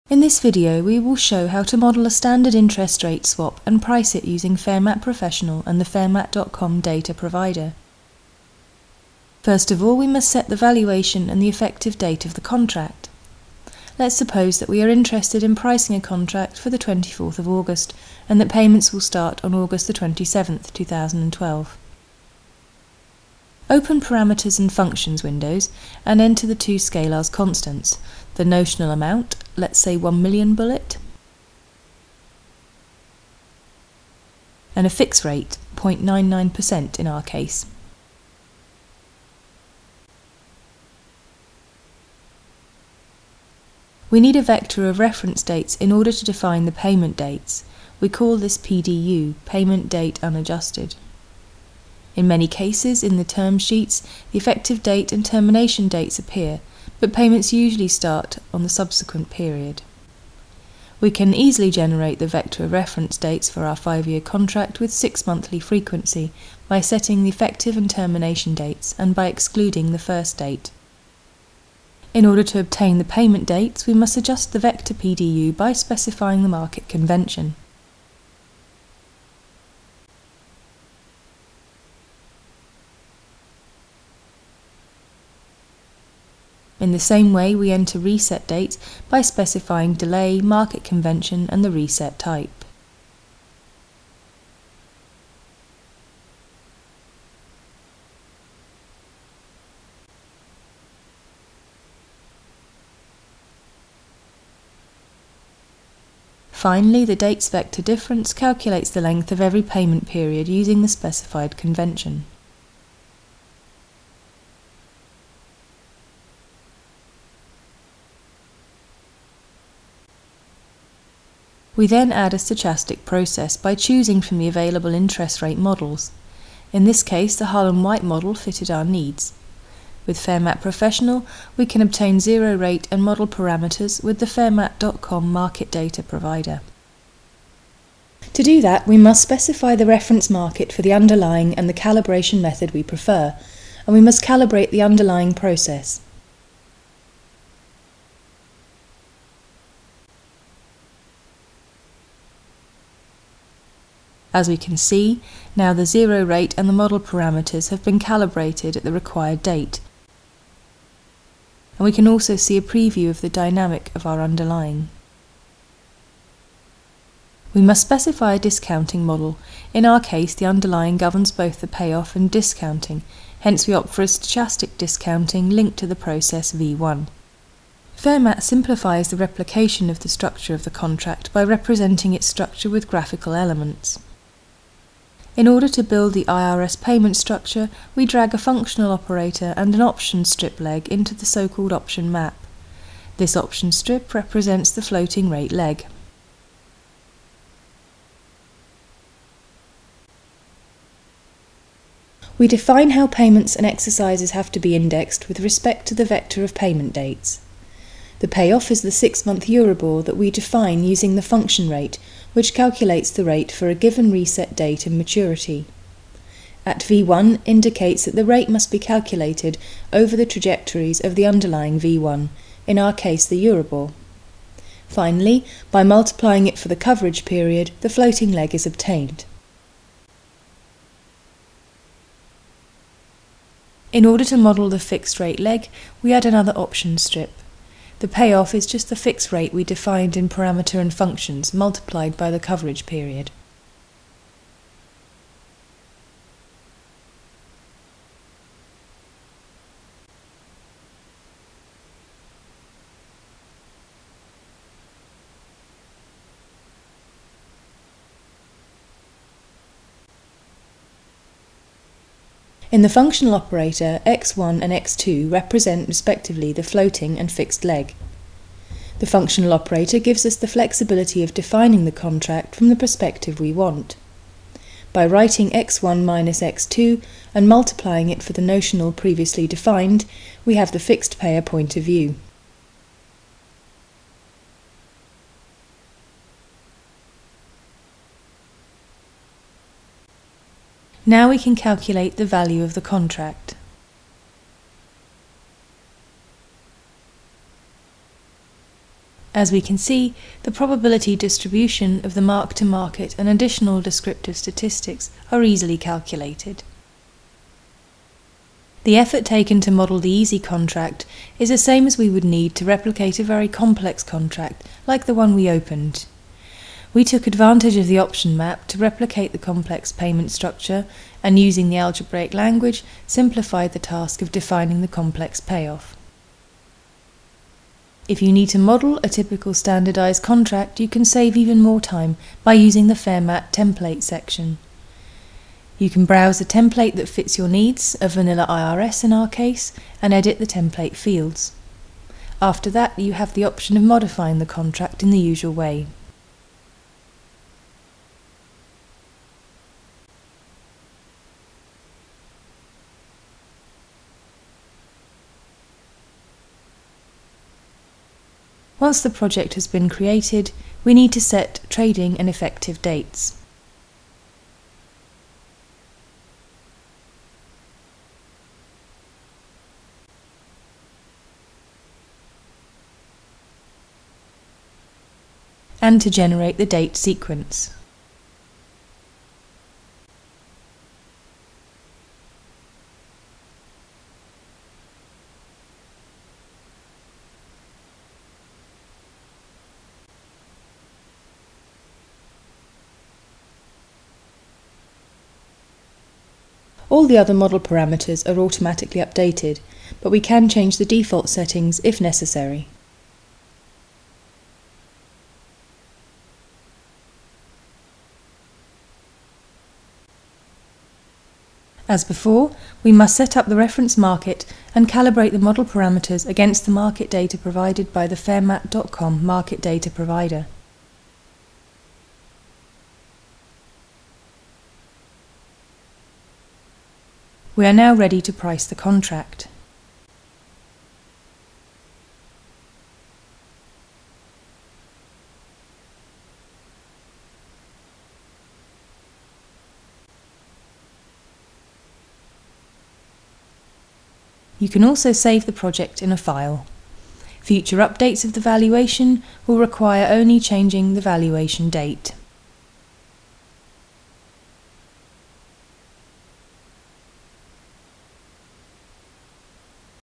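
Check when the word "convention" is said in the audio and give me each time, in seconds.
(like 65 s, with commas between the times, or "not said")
76 s, 90 s, 111 s.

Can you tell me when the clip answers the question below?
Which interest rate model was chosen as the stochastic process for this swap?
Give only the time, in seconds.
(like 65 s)
127 s.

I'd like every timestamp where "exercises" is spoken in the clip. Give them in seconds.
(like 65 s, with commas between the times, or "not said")
203 s.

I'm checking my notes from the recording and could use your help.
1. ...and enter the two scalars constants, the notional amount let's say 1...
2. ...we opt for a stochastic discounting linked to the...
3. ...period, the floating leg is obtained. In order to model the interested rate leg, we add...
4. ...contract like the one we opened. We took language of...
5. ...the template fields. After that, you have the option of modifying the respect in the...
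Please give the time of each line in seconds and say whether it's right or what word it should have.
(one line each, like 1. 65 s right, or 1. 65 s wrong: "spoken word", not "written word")
1. 26 s right
2. 173 s right
3. 227 s wrong: "fixed", not "interested"
4. 314 s wrong: "advantage", not "language"
5. 340 s wrong: "contract", not "respect".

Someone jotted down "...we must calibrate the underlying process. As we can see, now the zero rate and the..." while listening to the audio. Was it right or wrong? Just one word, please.
right.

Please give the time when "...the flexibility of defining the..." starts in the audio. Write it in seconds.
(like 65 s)
270 s.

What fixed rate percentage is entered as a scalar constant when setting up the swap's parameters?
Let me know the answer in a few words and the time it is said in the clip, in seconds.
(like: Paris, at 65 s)
0.99%, at 35 s.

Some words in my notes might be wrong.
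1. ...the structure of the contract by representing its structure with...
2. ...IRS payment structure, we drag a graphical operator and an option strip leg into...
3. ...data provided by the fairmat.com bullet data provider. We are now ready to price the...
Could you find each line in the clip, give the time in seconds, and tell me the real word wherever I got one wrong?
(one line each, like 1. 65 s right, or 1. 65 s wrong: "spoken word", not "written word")
1. 179 s right
2. 186 s wrong: "functional", not "graphical"
3. 417 s wrong: "market", not "bullet".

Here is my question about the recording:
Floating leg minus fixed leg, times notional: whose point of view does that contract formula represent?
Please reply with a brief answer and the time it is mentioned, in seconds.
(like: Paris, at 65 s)
fixed payer, at 280 s.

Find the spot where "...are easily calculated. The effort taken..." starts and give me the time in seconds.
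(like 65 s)
305 s.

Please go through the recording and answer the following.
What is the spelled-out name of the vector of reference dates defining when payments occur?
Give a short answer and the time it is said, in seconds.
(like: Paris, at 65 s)
Payment Date Unadjusted, at 49 s.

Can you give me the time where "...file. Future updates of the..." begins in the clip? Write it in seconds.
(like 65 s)
446 s.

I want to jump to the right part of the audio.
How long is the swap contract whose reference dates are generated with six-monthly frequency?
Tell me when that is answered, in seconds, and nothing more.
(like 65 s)
63 s.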